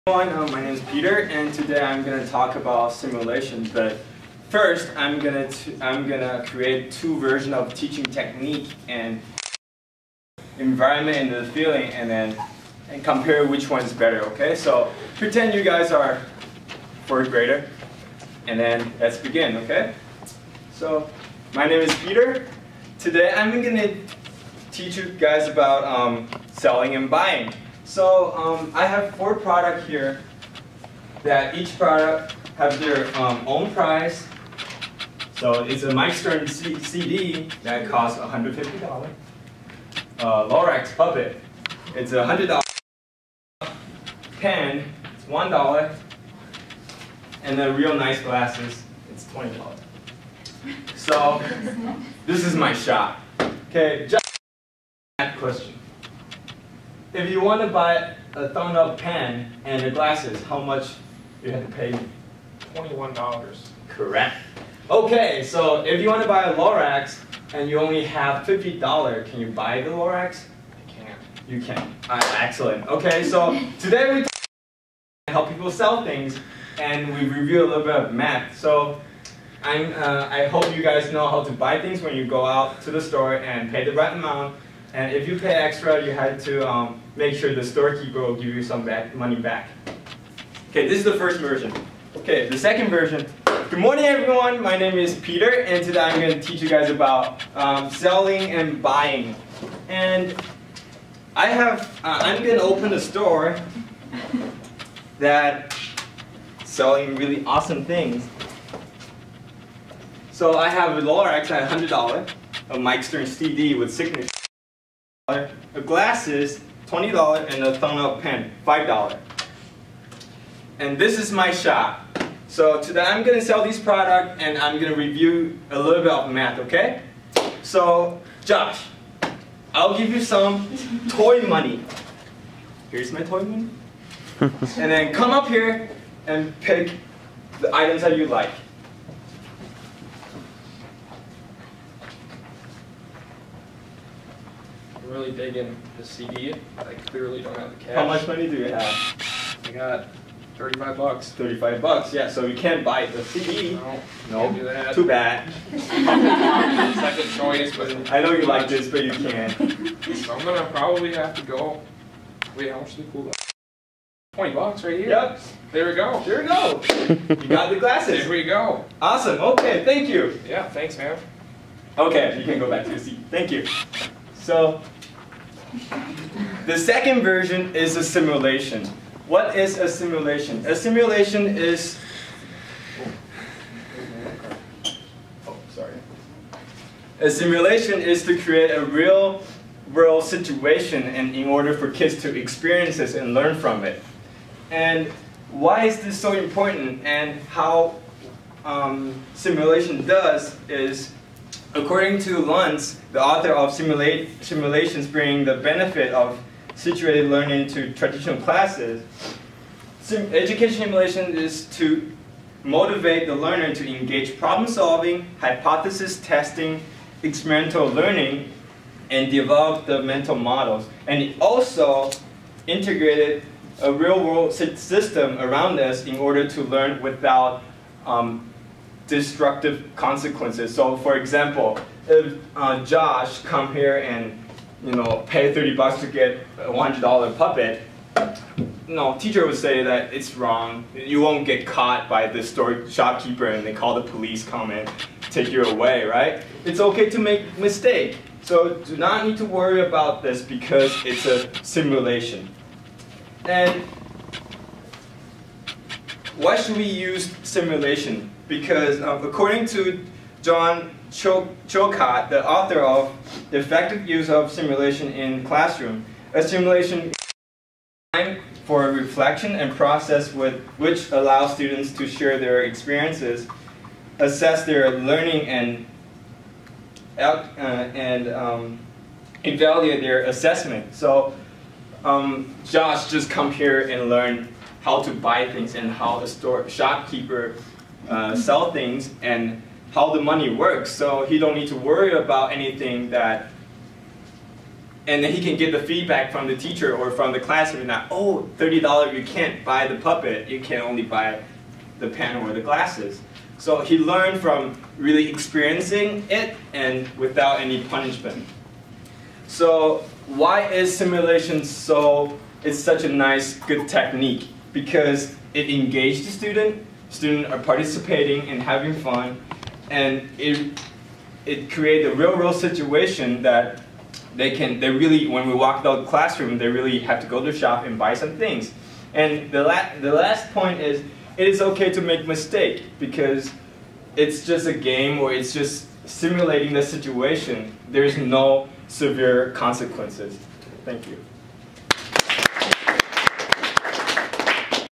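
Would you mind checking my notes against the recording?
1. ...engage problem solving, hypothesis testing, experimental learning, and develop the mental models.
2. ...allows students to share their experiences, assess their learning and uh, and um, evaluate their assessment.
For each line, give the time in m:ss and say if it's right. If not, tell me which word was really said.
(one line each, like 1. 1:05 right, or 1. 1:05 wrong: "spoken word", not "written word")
1. 3:33 right
2. 4:31 right.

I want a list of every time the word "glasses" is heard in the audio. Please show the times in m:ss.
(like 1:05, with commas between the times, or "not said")
0:48, 0:59, 1:55, 2:47, 5:02.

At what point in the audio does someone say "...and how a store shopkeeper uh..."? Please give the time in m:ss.
4:45.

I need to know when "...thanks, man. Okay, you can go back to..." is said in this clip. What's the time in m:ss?
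2:50.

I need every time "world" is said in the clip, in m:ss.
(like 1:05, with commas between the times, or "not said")
3:09, 3:44, 5:22.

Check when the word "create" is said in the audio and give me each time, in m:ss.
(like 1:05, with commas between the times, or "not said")
0:06, 3:08, 5:21.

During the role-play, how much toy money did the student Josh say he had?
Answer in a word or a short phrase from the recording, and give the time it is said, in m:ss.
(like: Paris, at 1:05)
$35, at 2:29.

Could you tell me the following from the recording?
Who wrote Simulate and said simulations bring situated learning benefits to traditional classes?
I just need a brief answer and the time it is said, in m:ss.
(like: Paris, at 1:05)
Luntz, at 3:22.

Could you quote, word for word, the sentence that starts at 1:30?
Okay, this is the first version.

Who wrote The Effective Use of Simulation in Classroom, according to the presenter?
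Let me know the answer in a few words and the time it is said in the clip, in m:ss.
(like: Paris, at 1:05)
John Chilcott, at 4:20.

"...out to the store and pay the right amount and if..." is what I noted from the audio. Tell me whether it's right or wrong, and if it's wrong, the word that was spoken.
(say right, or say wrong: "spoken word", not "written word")
right.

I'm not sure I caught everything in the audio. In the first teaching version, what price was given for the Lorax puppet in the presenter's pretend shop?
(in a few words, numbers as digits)
$100.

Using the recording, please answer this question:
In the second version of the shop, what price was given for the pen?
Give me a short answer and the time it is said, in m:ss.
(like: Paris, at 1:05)
$5, at 1:58.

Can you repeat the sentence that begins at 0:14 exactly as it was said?
Okay, so pretend you guys are fourth grader, and then let's begin.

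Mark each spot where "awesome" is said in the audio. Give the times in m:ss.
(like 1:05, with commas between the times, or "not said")
1:47, 2:49.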